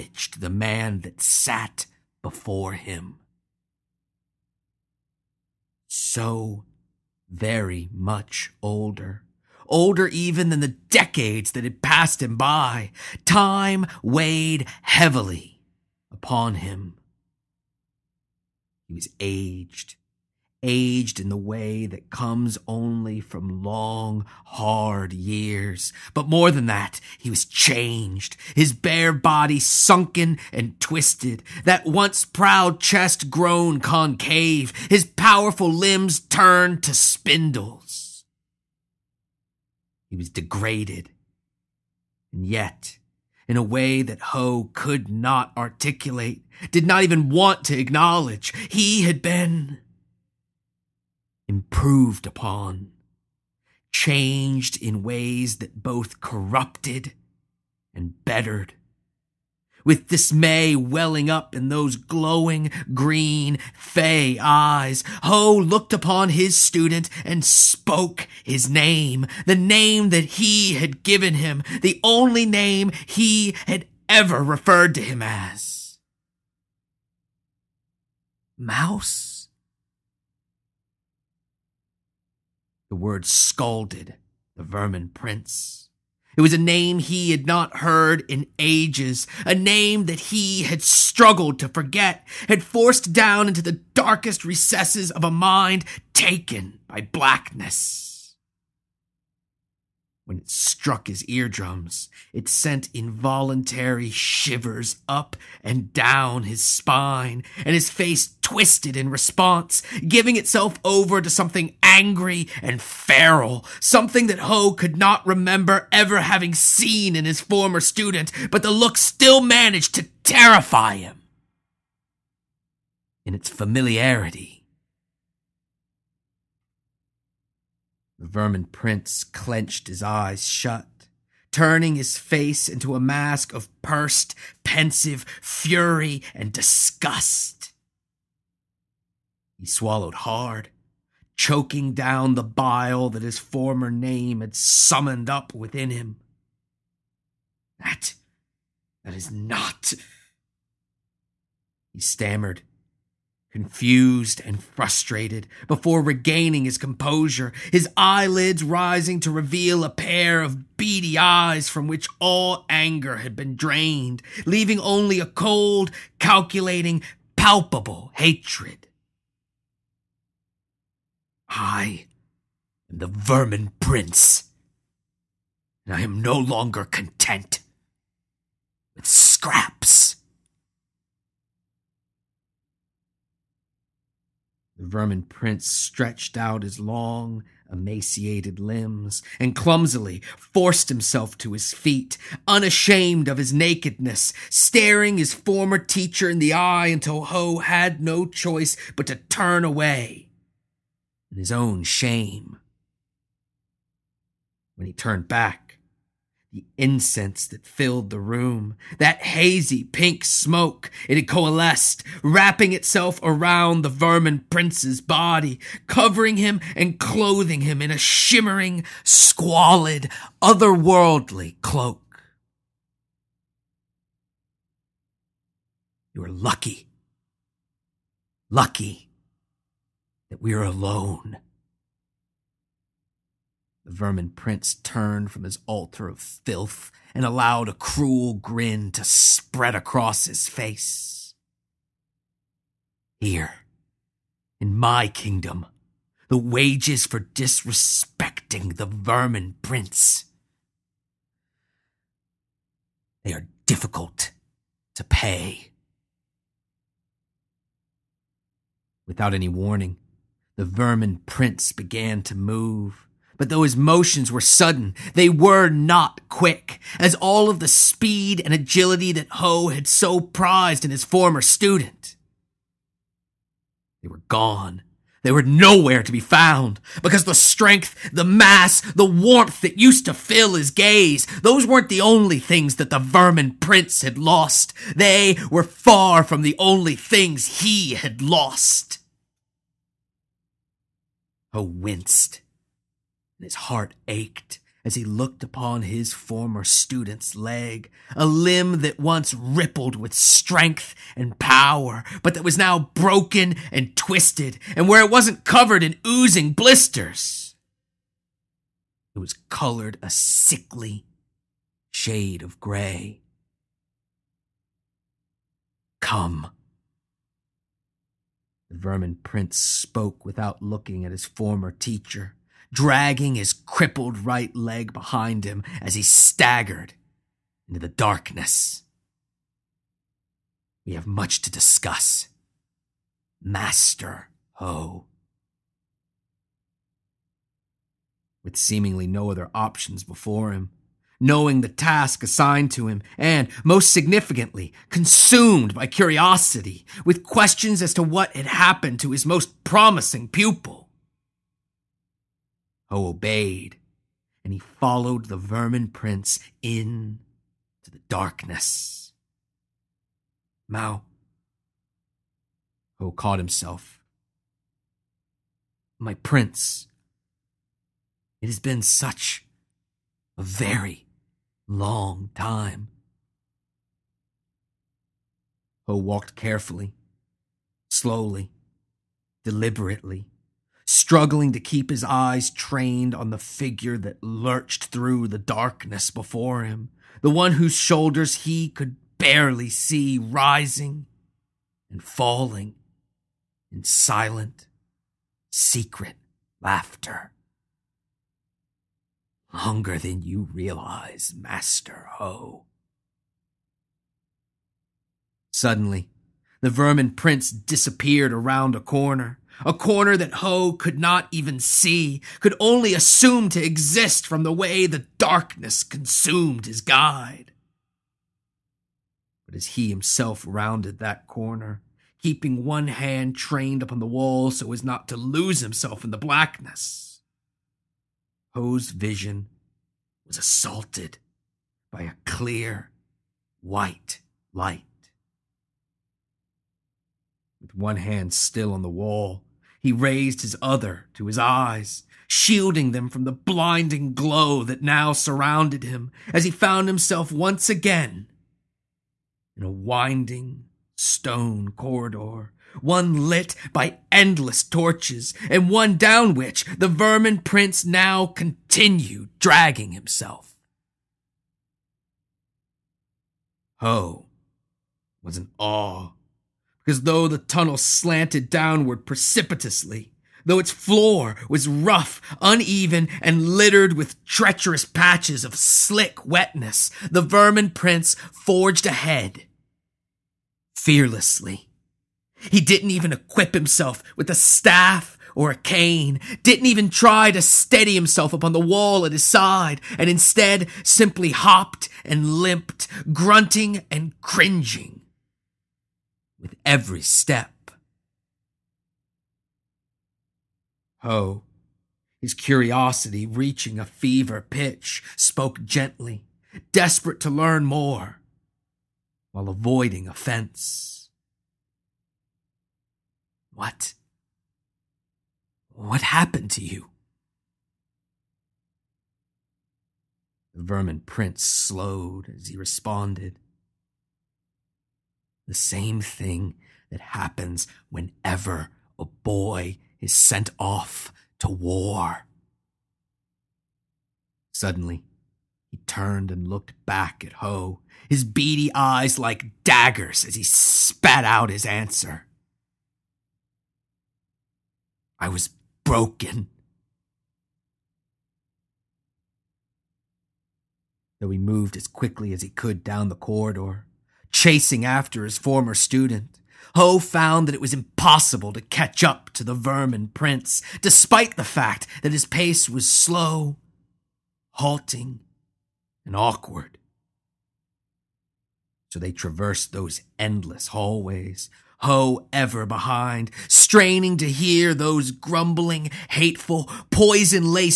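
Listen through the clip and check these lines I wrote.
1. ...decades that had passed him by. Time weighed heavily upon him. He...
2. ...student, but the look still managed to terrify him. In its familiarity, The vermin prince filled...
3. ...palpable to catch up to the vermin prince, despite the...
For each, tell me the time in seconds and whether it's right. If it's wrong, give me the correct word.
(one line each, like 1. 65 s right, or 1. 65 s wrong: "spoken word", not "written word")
1. 10 s right
2. 117 s wrong: "clenched", not "filled"
3. 557 s wrong: "impossible", not "palpable".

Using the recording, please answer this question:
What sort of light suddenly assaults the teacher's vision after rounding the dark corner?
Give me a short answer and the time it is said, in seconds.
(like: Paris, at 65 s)
Clear, white light, at 432 s.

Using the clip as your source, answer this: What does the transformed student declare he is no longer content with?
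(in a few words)
Scraps.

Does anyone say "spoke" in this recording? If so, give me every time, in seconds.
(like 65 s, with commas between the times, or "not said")
67 s, 319 s, 505 s.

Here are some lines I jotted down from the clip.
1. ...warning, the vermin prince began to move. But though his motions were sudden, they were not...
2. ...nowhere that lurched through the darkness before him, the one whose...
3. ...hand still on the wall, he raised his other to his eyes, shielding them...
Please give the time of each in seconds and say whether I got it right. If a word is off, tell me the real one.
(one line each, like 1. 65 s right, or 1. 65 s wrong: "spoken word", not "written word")
1. 259 s right
2. 383 s wrong: "figure", not "nowhere"
3. 437 s right.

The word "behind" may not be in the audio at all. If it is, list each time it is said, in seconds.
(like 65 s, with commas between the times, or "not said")
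324 s, 572 s.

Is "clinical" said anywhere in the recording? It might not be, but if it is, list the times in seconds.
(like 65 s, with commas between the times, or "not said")
not said.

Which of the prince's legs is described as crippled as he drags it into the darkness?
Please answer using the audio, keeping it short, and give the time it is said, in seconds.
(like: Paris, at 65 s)
Right leg, at 323 s.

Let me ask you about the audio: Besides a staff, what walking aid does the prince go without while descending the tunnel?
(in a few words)
A cane.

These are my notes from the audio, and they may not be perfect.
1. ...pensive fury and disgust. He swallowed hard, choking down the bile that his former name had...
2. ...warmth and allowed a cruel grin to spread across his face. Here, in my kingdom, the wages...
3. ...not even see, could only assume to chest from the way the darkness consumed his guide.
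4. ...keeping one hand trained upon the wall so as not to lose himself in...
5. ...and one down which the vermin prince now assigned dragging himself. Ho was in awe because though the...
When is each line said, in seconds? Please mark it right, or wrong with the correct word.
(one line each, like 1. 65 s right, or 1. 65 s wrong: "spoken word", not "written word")
1. 134 s right
2. 236 s wrong: "filth", not "warmth"
3. 410 s wrong: "exist", not "chest"
4. 422 s right
5. 455 s wrong: "continued", not "assigned".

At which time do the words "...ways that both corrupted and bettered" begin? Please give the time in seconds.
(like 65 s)
55 s.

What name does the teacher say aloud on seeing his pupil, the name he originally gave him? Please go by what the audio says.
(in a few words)
Mouse.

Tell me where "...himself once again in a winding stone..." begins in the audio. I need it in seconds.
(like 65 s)
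446 s.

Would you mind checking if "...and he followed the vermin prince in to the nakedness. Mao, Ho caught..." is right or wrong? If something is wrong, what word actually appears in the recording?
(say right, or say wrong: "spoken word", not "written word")
wrong: "darkness", not "nakedness".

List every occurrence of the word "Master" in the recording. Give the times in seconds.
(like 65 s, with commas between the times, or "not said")
333 s, 401 s.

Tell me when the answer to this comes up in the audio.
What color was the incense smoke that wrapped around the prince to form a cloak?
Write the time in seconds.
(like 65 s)
209 s.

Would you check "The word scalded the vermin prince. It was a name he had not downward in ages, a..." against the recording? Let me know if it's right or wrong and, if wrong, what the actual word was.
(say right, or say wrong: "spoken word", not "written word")
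wrong: "heard", not "downward".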